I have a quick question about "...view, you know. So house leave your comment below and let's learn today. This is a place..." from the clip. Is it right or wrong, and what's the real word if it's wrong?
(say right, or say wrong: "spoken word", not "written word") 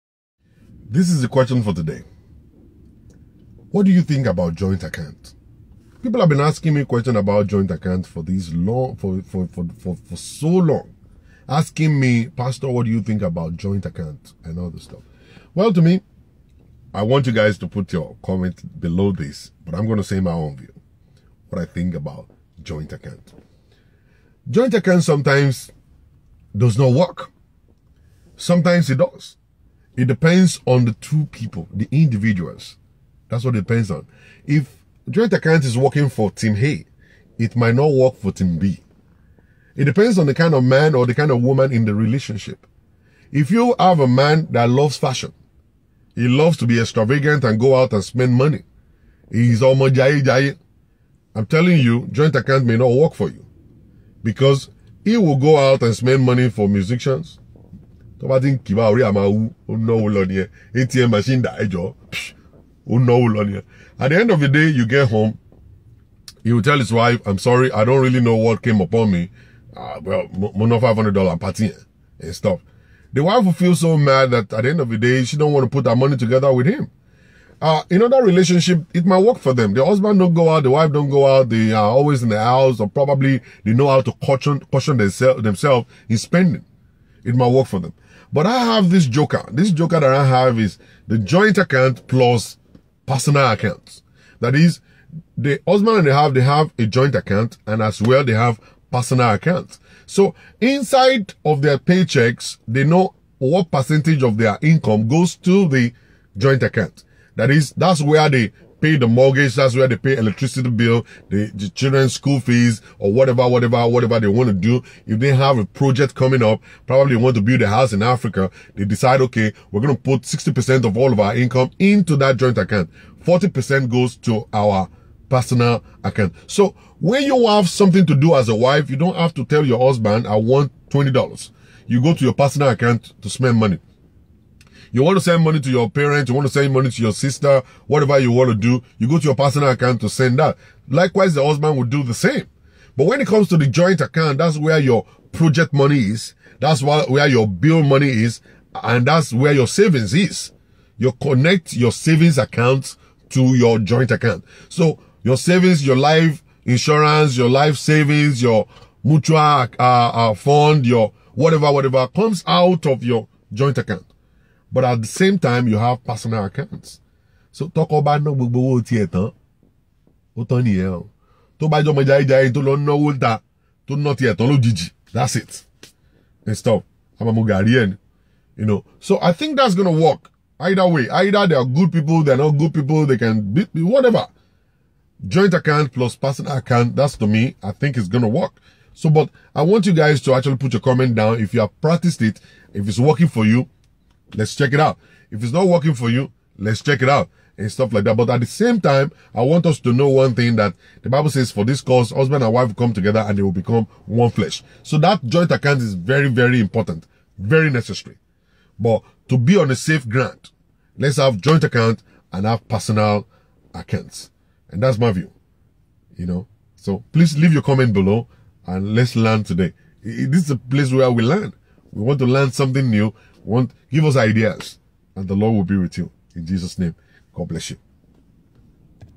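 wrong: "please", not "house".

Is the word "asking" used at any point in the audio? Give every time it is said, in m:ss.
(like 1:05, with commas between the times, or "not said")
0:06, 0:11.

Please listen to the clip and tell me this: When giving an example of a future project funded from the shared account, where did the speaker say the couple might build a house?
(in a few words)
Africa.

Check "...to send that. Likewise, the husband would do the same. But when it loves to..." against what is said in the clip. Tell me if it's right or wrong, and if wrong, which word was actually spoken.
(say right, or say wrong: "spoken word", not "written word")
wrong: "comes", not "loves".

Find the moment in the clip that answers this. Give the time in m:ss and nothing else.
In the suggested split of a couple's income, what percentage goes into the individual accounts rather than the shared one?
2:03.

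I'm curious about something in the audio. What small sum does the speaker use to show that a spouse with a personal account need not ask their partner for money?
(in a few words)
$20.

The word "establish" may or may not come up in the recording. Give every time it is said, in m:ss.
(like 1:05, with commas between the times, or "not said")
not said.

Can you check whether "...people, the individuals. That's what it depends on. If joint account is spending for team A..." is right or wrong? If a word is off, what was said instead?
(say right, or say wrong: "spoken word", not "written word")
wrong: "working", not "spending".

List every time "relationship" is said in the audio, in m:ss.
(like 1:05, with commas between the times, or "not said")
0:41, 1:18.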